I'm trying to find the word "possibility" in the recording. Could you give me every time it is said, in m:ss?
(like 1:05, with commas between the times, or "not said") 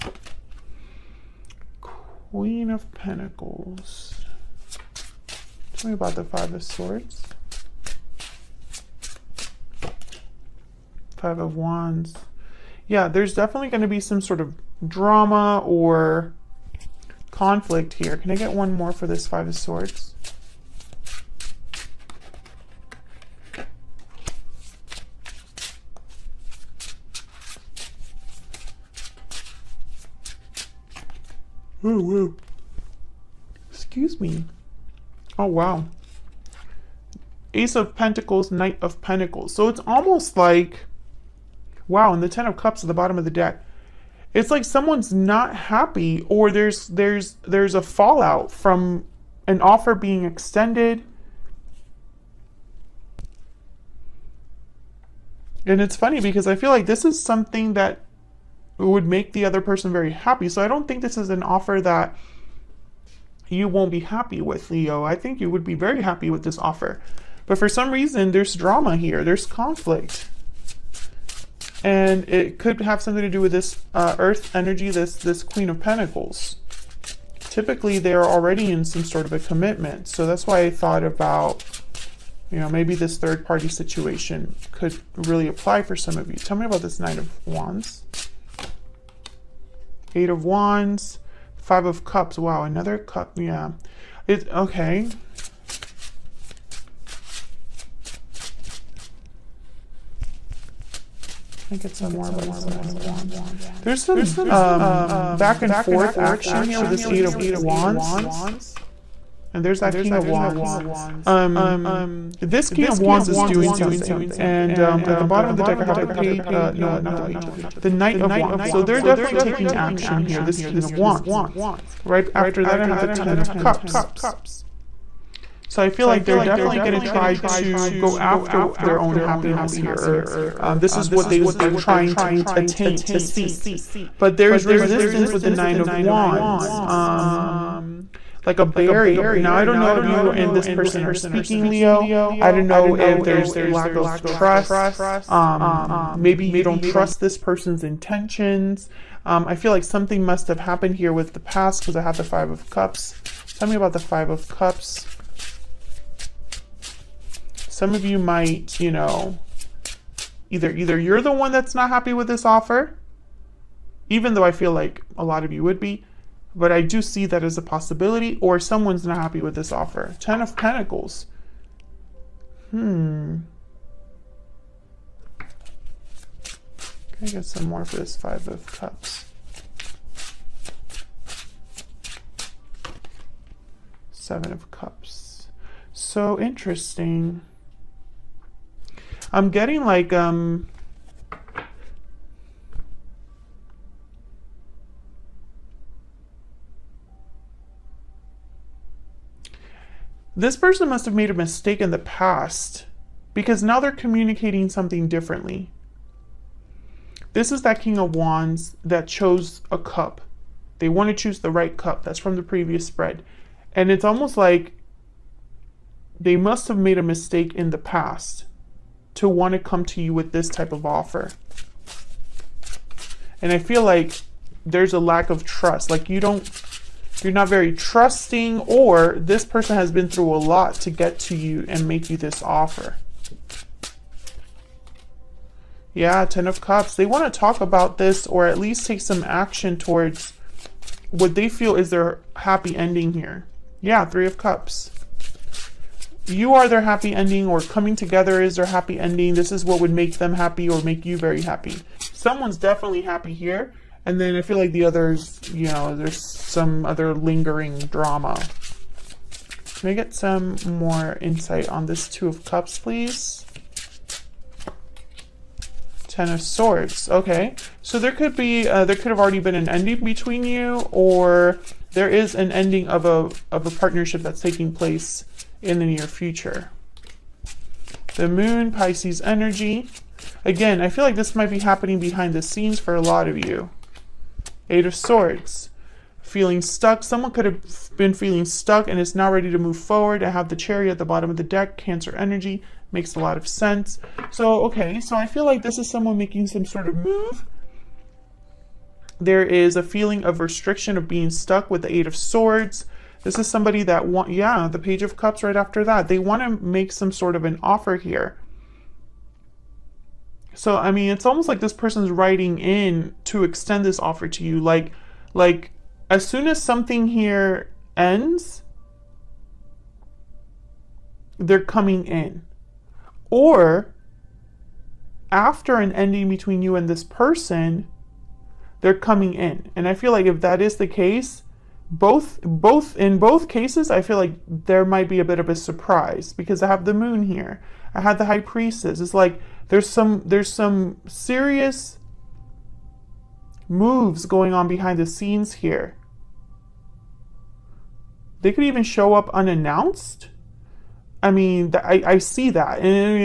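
2:47.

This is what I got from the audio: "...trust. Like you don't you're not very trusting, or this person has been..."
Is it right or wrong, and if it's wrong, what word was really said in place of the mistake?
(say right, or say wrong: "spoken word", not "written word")
right.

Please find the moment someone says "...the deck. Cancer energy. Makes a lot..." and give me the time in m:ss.
4:51.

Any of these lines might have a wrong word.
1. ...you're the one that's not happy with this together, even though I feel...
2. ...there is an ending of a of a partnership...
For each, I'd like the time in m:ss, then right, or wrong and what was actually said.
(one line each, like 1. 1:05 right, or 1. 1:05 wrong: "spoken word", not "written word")
1. 2:40 wrong: "offer", not "together"
2. 4:31 right.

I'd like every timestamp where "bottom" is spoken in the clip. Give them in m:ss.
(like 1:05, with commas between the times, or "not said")
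0:42, 1:55, 4:51.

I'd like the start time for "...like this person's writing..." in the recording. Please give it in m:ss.
5:11.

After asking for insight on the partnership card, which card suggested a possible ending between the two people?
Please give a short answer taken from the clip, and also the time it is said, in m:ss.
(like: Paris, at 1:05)
Ten of Swords, at 4:26.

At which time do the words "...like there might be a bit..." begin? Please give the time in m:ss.
5:34.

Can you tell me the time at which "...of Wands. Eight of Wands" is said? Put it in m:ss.
1:27.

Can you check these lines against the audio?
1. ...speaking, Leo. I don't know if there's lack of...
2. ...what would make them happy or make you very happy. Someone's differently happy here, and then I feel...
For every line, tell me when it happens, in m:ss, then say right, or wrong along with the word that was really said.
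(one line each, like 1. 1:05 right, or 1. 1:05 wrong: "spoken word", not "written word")
1. 2:21 right
2. 4:09 wrong: "definitely", not "differently".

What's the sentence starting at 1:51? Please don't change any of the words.
Um, this King of Wands is doing something.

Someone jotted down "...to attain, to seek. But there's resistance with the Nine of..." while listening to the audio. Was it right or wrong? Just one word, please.
right.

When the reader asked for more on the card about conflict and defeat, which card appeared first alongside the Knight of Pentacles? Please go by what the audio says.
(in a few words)
Ace of Pentacles.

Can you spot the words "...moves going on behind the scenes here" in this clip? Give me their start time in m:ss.
5:43.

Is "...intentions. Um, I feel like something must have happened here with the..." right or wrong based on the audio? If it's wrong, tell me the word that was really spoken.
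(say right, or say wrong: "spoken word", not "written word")
right.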